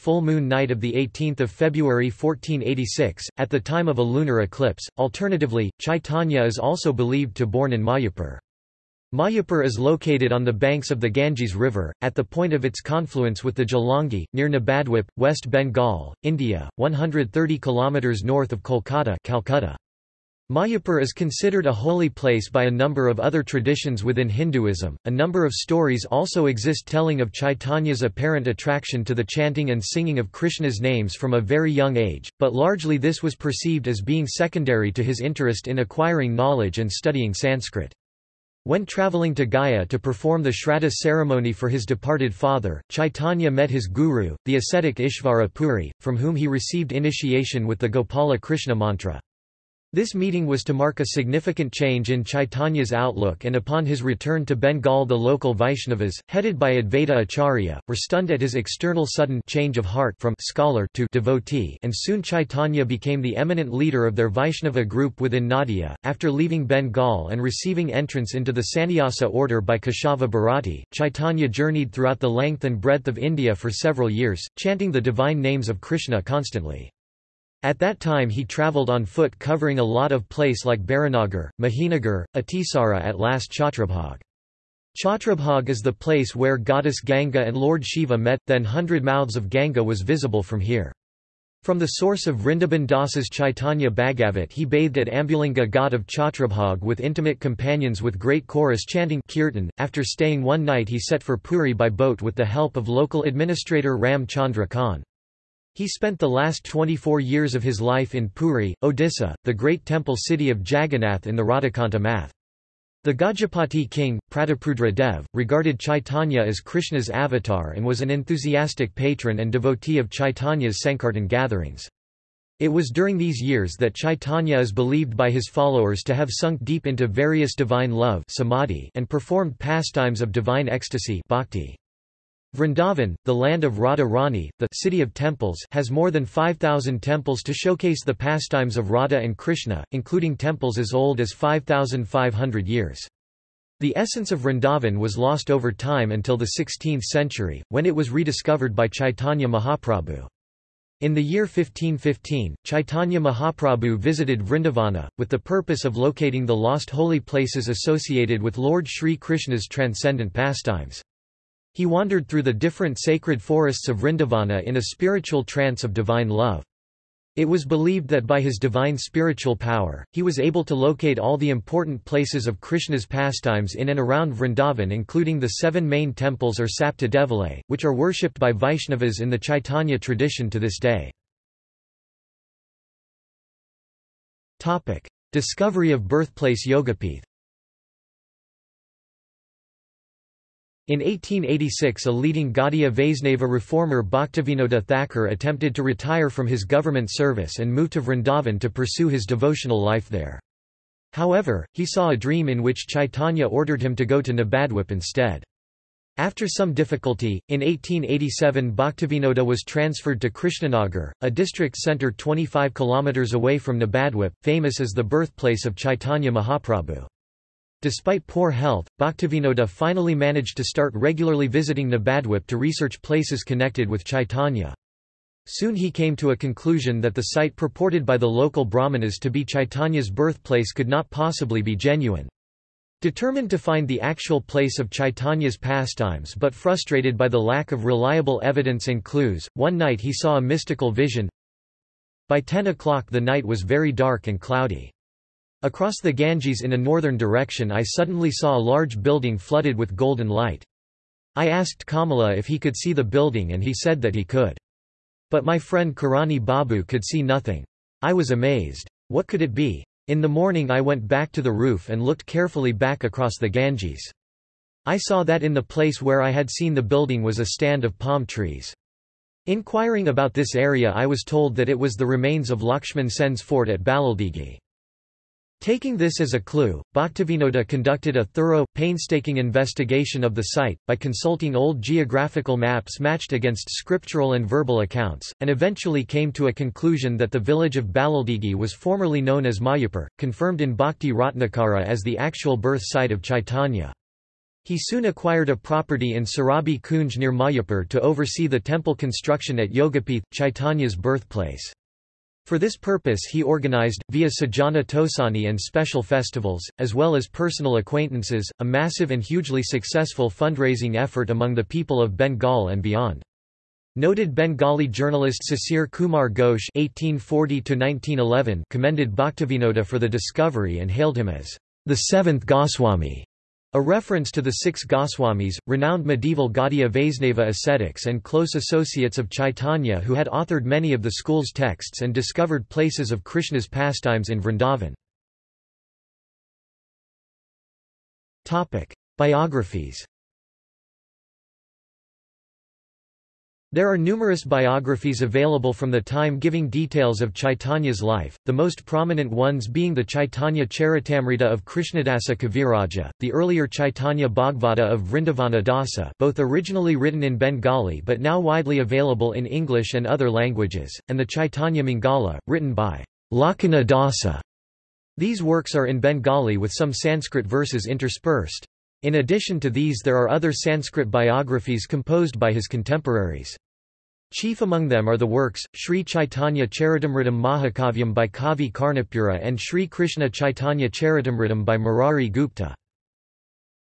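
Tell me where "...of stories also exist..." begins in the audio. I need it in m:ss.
0:25.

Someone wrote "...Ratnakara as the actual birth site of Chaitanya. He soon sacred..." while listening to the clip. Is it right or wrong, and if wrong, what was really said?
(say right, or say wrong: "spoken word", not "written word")
wrong: "acquired", not "sacred".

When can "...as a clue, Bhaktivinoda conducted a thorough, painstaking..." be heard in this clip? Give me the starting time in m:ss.
4:36.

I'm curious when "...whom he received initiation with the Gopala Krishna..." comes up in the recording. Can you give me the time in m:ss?
0:46.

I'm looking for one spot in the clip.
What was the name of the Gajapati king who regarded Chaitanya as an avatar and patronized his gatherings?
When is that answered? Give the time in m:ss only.
1:54.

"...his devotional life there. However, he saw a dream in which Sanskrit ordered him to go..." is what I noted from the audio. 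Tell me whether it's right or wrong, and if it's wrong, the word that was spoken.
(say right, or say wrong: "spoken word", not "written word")
wrong: "Chaitanya", not "Sanskrit".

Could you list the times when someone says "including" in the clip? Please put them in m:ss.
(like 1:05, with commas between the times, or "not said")
2:19, 2:54.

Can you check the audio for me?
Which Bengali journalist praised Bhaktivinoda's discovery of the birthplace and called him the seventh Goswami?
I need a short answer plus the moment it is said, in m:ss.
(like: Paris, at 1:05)
Sisir Kumar Ghosh, at 5:15.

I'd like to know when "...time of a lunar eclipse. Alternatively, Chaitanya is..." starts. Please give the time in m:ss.
0:03.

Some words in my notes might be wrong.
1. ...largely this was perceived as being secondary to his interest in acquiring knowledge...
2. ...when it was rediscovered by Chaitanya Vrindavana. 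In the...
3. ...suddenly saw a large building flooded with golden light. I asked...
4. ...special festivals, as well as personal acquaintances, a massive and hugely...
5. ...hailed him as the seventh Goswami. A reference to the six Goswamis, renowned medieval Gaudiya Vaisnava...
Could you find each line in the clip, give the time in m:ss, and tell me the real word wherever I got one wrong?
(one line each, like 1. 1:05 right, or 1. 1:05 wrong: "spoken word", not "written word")
1. 0:32 right
2. 2:27 wrong: "Mahaprabhu", not "Vrindavana"
3. 4:07 right
4. 5:05 right
5. 5:20 right.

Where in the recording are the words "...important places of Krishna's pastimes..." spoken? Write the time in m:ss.
2:51.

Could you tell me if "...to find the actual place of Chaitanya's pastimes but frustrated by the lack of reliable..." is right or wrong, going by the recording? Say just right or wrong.
right.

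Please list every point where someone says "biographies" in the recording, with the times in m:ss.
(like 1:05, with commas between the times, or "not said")
5:39, 5:44, 6:11.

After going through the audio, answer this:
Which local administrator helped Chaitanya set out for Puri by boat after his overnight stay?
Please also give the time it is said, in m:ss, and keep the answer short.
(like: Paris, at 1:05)
Ram Chandra Khan, at 1:43.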